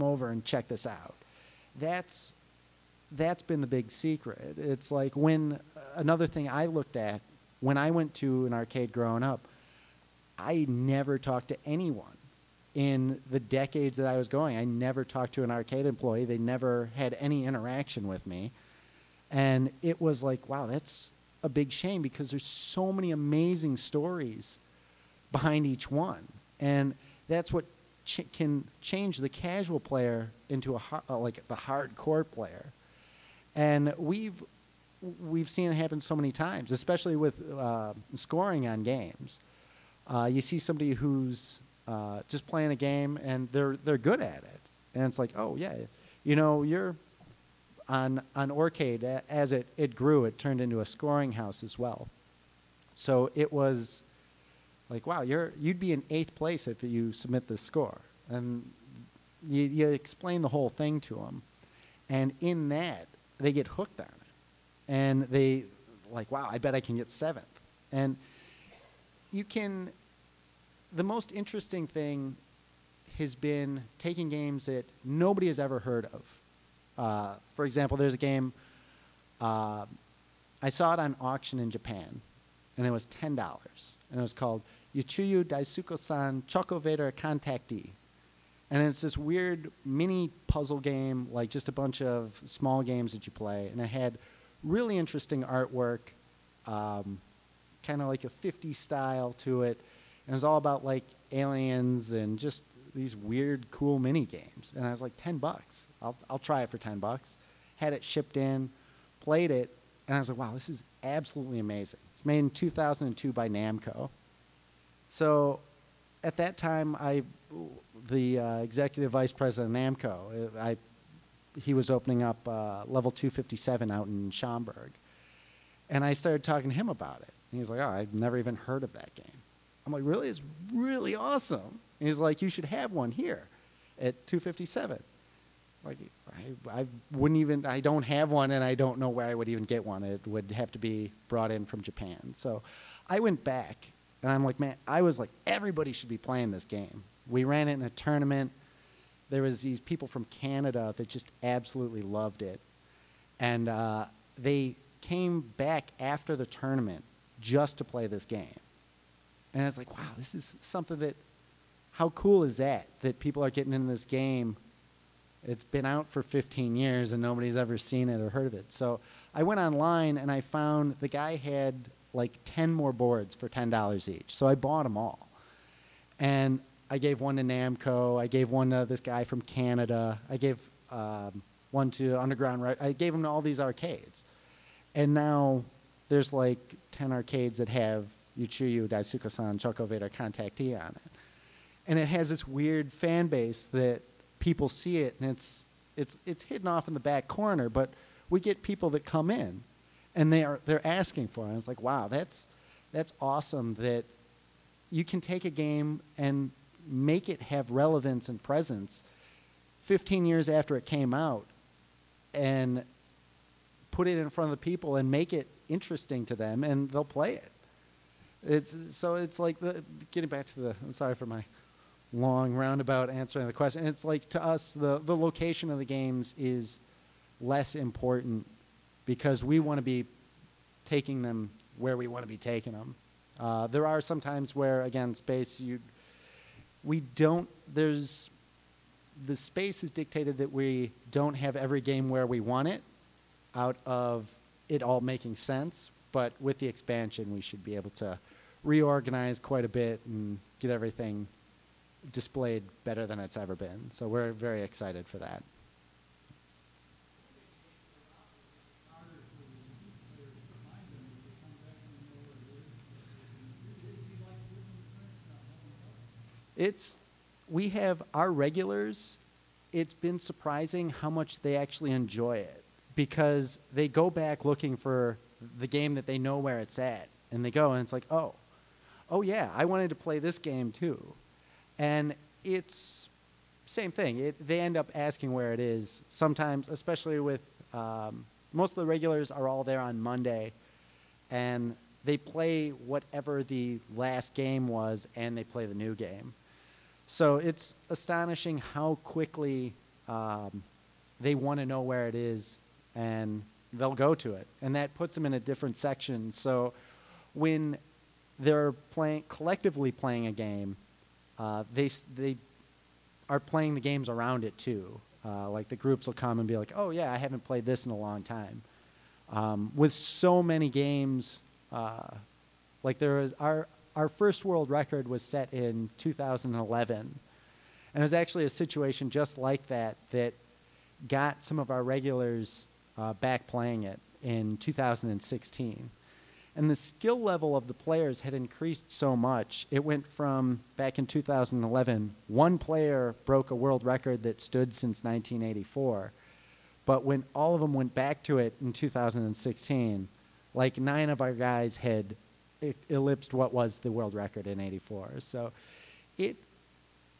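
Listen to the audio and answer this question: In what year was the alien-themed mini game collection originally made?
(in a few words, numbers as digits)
2002.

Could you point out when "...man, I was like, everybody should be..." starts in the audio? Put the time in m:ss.
2:24.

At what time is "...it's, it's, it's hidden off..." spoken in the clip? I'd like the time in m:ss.
3:15.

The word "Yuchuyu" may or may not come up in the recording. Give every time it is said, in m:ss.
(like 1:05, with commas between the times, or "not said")
1:24, 3:08.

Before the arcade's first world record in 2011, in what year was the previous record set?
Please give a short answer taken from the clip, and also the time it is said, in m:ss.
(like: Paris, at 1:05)
1984, at 5:45.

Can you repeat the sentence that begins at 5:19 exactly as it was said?
Um, with so many games, uh, like there is, our, our first world record was set in 2011.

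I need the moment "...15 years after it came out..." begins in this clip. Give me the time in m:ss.
3:29.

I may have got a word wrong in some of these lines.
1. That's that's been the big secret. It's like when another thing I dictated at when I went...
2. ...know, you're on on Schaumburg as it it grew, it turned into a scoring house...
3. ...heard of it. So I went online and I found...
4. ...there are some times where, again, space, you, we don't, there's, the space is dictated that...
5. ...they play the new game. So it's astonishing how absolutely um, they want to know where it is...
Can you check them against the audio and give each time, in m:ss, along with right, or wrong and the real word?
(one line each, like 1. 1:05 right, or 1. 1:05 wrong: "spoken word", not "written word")
1. 0:01 wrong: "looked", not "dictated"
2. 0:46 wrong: "Aurcade", not "Schaumburg"
3. 2:48 right
4. 3:53 right
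5. 4:55 wrong: "quickly", not "absolutely".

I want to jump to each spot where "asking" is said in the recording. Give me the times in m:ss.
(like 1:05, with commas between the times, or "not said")
3:20, 4:44.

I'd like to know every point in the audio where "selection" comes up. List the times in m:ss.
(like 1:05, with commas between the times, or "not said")
not said.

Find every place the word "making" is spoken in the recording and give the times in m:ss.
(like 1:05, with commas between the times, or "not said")
4:05.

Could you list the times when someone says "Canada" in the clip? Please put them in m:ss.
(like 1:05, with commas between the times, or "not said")
2:30, 2:59.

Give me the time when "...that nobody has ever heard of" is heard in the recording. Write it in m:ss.
1:14.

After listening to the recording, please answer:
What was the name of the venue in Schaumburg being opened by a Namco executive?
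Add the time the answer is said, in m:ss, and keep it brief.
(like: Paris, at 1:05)
Level 257, at 2:02.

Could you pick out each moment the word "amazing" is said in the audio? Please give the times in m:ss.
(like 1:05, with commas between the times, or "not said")
0:23, 1:51.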